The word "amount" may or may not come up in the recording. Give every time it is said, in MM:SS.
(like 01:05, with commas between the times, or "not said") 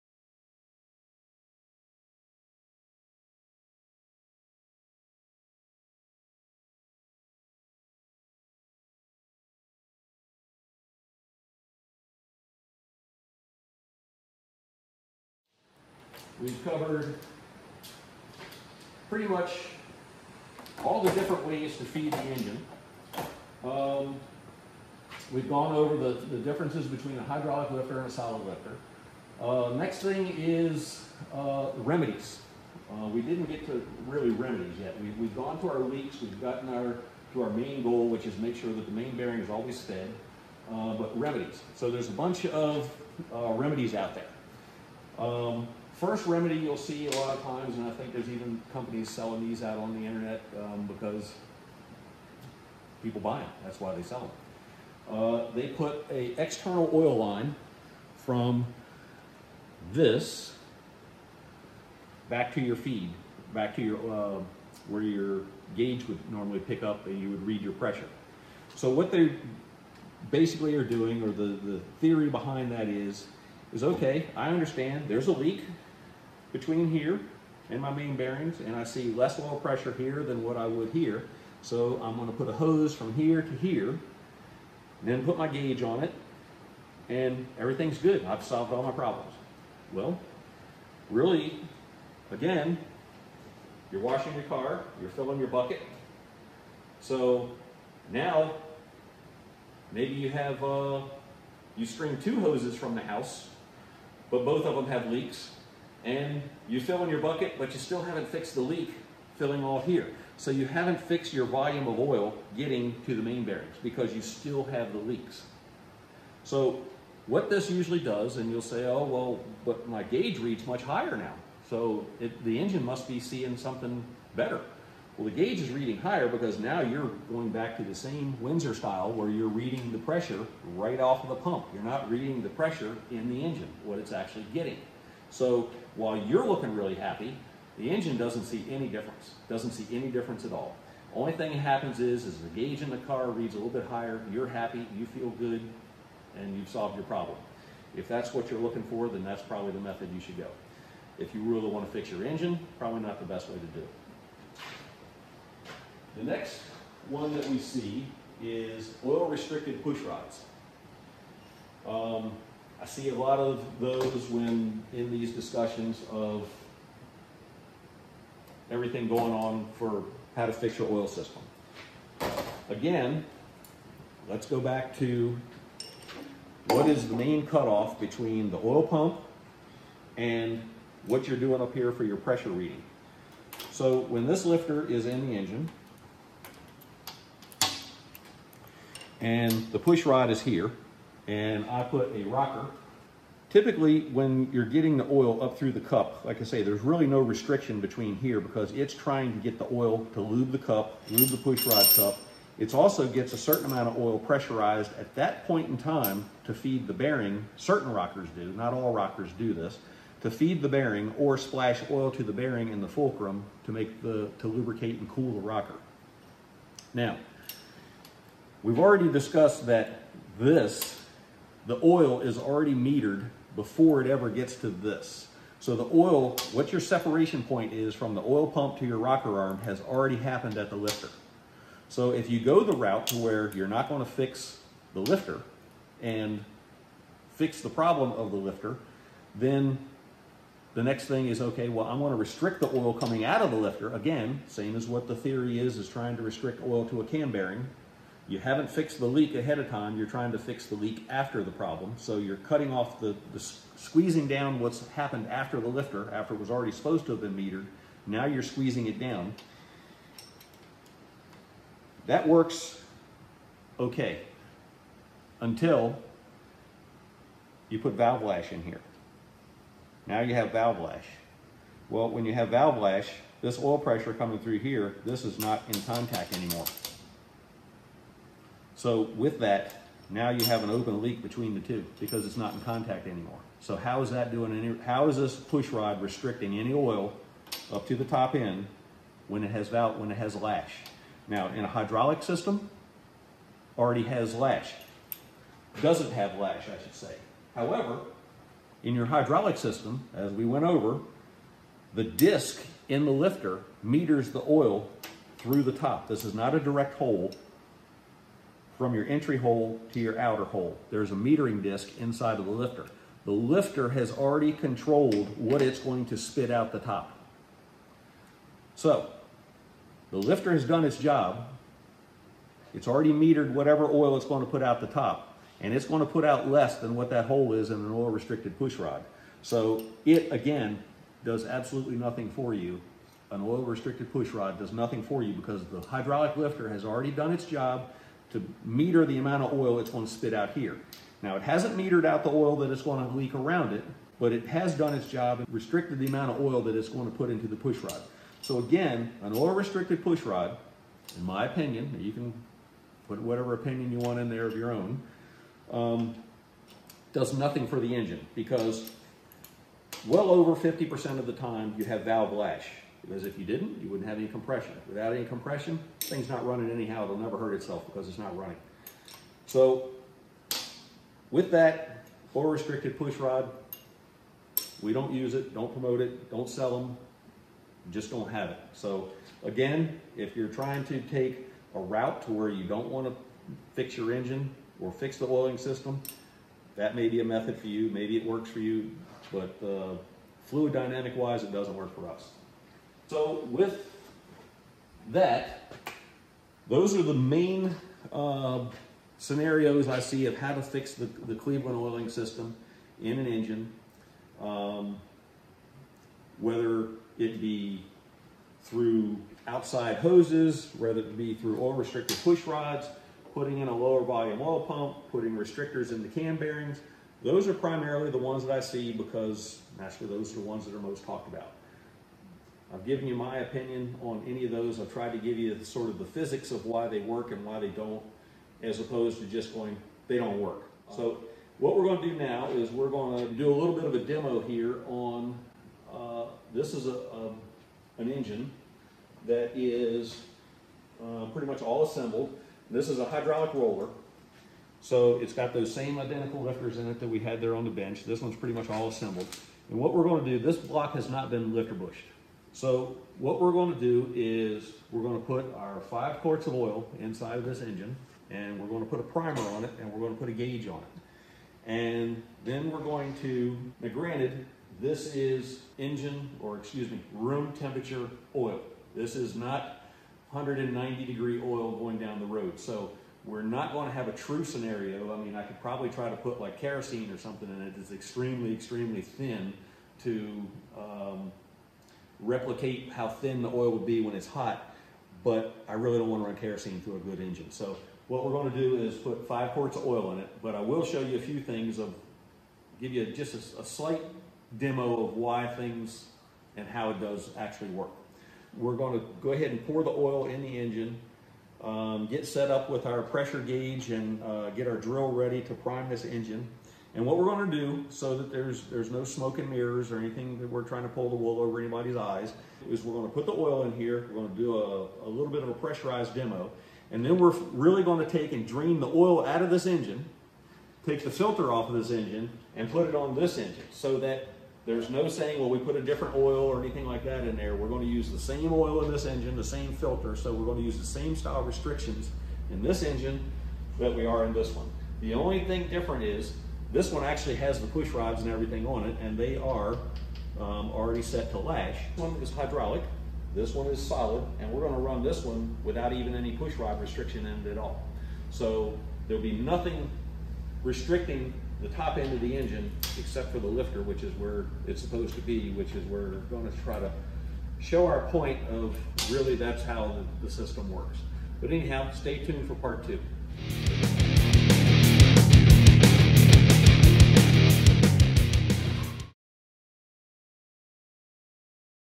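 03:23, 05:39, 05:46.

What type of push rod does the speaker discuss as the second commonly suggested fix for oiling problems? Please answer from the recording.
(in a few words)
Oil-restricted push rods.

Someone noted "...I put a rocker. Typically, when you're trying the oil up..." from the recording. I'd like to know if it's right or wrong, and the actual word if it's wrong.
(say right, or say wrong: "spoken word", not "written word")
wrong: "getting", not "trying".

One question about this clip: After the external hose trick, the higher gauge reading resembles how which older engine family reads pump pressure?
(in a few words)
Windsor.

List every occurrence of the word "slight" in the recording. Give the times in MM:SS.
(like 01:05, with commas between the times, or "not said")
08:13.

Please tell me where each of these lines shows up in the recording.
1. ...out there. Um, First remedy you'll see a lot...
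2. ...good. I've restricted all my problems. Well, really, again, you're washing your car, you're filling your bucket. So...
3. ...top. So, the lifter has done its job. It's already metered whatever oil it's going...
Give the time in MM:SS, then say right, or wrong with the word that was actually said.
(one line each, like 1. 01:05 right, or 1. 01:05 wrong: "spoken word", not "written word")
1. 00:43 right
2. 01:27 wrong: "solved", not "restricted"
3. 05:16 right.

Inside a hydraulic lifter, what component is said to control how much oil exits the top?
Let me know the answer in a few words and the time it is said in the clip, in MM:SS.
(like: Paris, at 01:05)
Metering disc, at 05:11.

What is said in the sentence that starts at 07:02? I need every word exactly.
I've given you my opinion on any of those.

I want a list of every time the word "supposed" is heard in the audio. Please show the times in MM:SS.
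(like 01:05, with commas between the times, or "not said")
04:16, 09:14.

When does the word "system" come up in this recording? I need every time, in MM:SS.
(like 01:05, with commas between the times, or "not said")
02:51, 04:52, 04:59, 06:25, 06:42, 09:20.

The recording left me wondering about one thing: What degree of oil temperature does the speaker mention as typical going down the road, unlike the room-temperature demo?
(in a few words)
190 degrees.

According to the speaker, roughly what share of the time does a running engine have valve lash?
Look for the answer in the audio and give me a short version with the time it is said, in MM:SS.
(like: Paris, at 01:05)
Over 50%, at 06:00.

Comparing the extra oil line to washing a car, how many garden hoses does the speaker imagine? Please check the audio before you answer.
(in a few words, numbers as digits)
2.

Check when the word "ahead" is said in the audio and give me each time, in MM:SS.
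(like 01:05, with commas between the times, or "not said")
04:09, 08:19.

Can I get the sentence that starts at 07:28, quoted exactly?
This one's pretty much all assembled.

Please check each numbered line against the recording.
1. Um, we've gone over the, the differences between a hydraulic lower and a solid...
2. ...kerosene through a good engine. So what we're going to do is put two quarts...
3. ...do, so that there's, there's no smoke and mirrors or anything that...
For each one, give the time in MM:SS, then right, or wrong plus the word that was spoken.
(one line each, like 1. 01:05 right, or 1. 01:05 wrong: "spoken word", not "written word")
1. 00:23 wrong: "lifter", not "lower"
2. 08:06 wrong: "five", not "two"
3. 08:27 right.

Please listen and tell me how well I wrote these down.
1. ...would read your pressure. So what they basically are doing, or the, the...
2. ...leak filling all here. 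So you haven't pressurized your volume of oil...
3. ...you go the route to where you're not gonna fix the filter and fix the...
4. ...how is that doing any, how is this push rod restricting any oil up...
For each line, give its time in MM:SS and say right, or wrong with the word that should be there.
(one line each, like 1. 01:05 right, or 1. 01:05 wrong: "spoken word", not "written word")
1. 01:07 right
2. 01:48 wrong: "fixed", not "pressurized"
3. 03:52 wrong: "lifter", not "filter"
4. 04:43 right.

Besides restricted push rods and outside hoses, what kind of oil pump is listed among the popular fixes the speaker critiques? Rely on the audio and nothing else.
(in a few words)
Lower volume oil pump.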